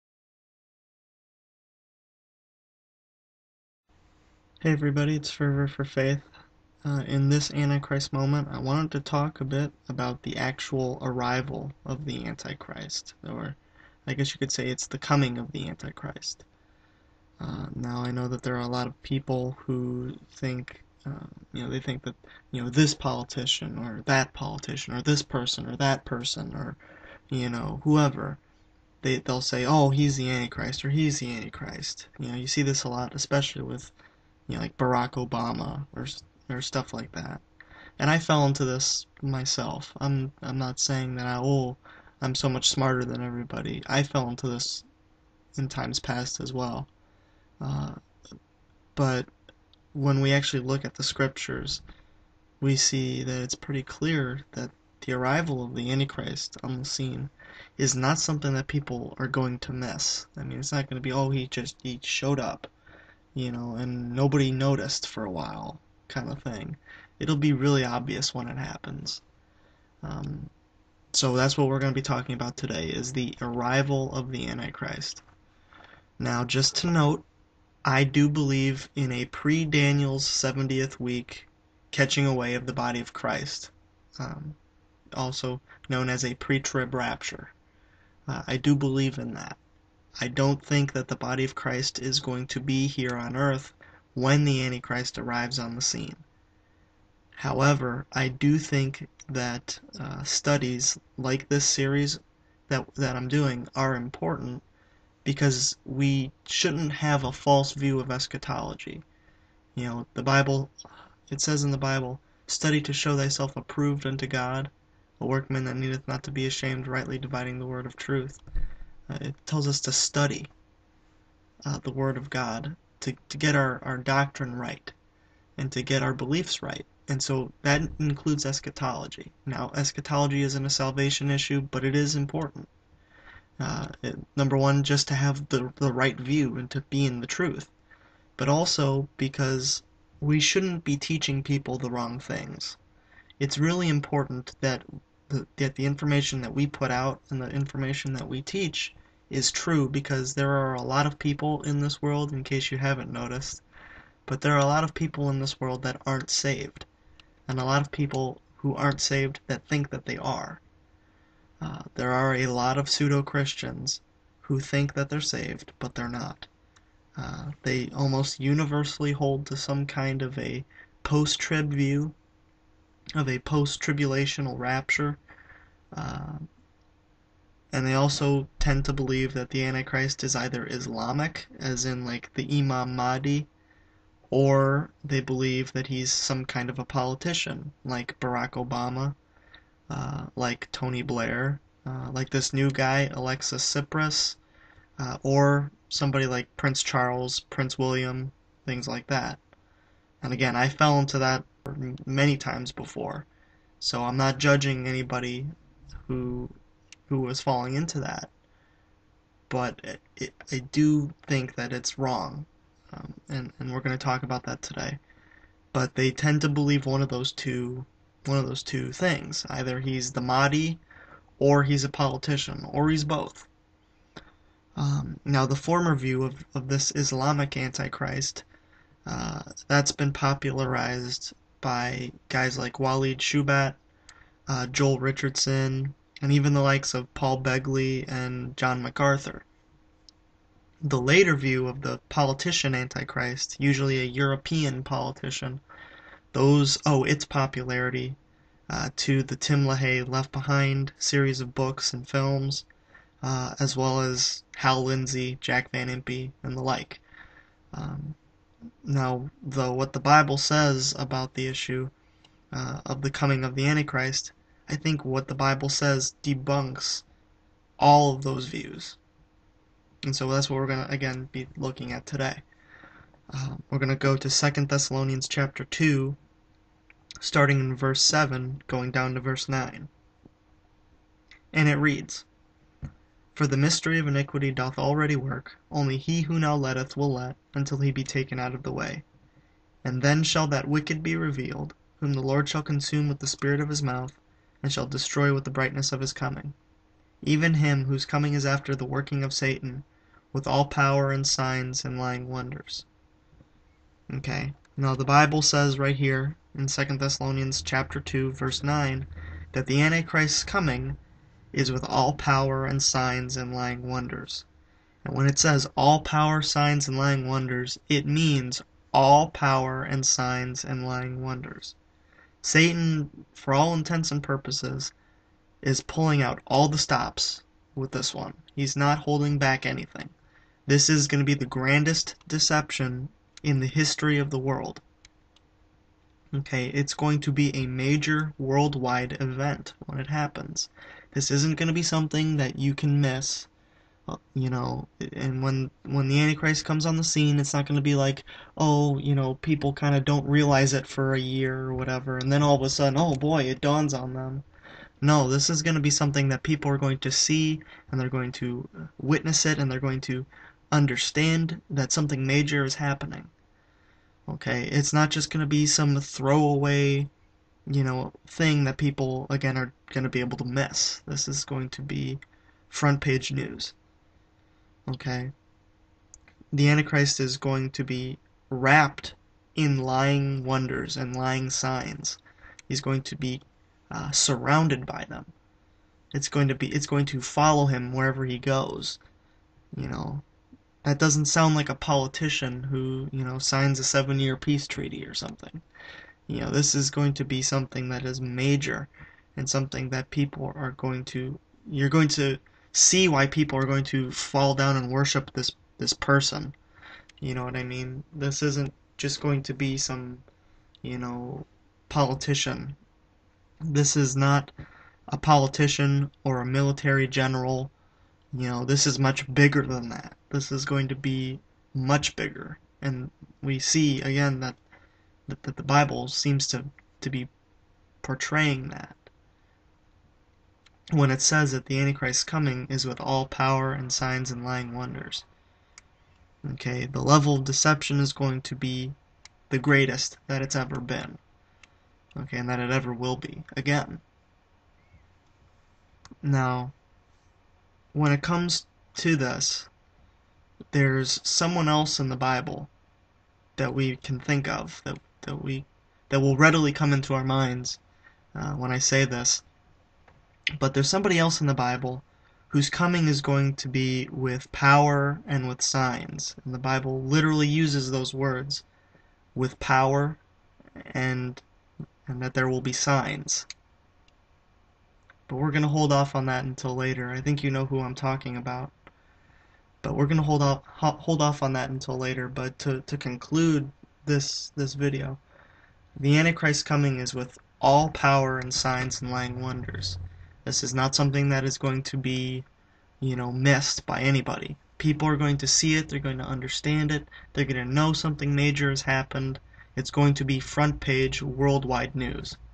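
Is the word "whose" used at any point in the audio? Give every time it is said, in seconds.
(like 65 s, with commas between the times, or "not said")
297 s, 462 s.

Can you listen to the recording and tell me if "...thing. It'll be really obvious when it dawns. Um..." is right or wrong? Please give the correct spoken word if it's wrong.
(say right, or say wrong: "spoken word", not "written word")
wrong: "happens", not "dawns".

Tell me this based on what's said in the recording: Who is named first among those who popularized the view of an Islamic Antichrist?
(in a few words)
Walid Shoebat.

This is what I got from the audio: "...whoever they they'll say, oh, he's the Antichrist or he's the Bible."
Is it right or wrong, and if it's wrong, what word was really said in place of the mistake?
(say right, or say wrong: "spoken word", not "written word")
wrong: "Antichrist", not "Bible".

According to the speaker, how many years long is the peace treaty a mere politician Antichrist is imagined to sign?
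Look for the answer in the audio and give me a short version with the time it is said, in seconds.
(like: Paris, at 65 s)
7, at 393 s.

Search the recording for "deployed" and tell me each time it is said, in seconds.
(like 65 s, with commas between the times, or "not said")
not said.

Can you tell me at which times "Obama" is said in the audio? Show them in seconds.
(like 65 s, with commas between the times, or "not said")
35 s, 188 s.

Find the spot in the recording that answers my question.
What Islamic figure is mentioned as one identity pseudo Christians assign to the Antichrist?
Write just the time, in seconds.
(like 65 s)
182 s.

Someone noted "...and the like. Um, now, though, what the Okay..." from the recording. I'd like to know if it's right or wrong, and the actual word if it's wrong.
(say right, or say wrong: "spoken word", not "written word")
wrong: "Bible", not "Okay".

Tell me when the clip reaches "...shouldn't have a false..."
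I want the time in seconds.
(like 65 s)
106 s.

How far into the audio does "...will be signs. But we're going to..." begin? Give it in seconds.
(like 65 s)
472 s.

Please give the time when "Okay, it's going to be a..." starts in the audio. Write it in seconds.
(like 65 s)
336 s.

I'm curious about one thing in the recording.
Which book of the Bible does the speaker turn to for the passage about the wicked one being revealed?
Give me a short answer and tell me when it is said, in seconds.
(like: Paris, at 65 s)
Second Thessalonians, at 274 s.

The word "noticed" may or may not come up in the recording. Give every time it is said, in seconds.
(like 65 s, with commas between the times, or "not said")
64 s, 153 s.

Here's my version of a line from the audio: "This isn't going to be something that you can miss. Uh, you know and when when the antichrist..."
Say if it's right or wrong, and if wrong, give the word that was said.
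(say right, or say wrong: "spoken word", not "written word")
right.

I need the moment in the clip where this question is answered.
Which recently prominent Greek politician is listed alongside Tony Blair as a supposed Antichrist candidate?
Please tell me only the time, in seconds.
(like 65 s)
193 s.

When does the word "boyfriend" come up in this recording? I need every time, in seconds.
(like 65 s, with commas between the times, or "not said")
not said.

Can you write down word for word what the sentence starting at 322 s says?
Satan, for all intents and purposes, is pulling out all the stops with this one.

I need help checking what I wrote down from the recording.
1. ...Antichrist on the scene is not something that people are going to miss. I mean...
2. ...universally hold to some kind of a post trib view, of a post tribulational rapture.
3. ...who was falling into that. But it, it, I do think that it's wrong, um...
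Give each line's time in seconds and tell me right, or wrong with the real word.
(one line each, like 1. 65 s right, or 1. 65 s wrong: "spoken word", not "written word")
1. 55 s right
2. 168 s right
3. 207 s right.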